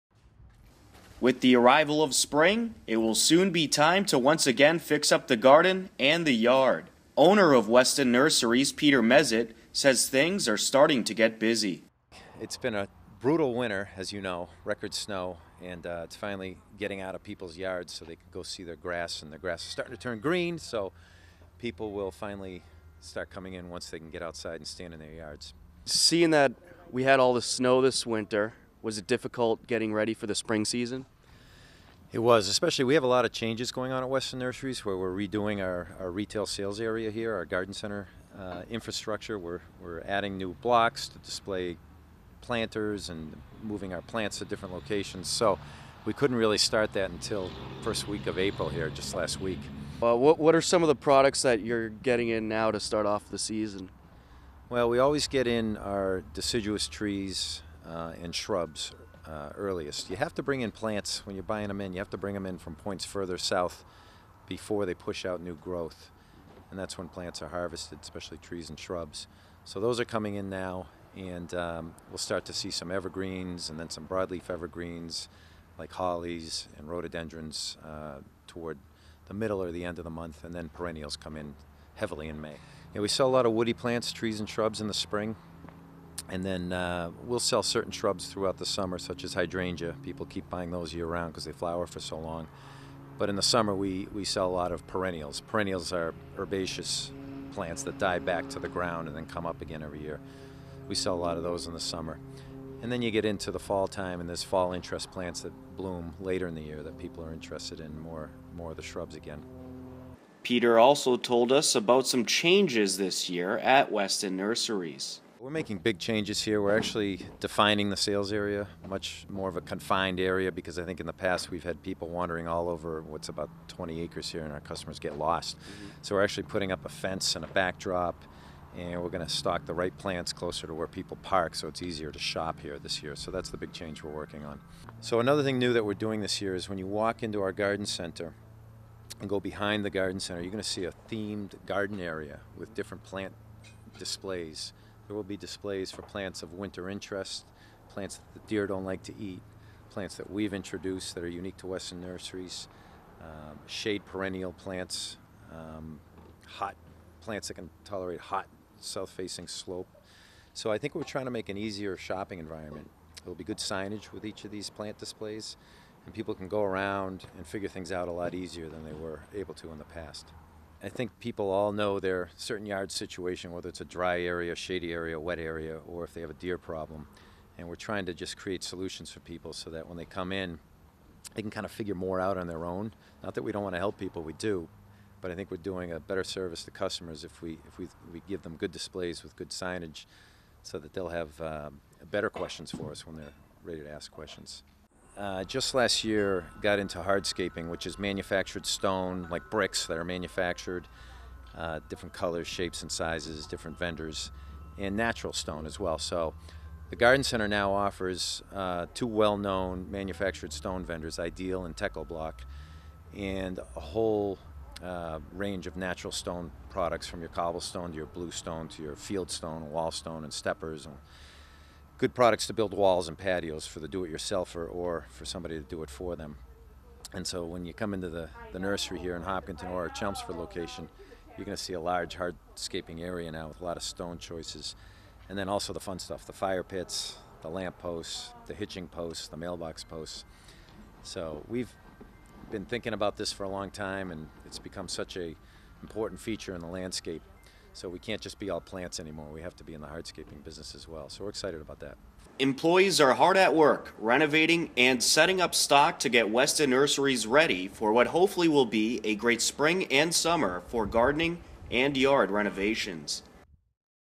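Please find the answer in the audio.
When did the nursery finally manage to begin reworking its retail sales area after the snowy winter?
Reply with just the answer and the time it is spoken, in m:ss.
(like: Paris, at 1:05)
First week of April, at 0:47.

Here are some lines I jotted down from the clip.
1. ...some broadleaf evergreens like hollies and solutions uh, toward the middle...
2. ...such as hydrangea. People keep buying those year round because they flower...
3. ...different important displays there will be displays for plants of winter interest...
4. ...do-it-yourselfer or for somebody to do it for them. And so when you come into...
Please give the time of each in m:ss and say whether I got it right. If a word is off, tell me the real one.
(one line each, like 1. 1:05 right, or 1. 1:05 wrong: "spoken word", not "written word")
1. 1:13 wrong: "rhododendrons", not "solutions"
2. 1:28 right
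3. 2:22 wrong: "plant", not "important"
4. 3:43 right.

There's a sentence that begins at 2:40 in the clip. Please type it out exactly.
So I think we're trying to make an easier shopping environment.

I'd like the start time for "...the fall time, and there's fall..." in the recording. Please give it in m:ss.
1:43.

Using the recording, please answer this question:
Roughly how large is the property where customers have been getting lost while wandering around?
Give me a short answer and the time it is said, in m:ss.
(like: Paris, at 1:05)
20 acres, at 2:03.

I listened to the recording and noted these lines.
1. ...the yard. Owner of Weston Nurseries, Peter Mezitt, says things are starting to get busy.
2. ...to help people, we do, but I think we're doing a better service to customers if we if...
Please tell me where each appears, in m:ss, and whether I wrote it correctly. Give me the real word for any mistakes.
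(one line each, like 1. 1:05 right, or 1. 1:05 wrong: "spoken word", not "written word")
1. 0:06 right
2. 3:03 right.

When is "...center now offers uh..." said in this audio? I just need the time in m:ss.
3:27.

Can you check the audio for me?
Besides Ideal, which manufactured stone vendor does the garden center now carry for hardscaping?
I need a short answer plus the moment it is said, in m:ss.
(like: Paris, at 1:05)
Techo-Bloc, at 3:31.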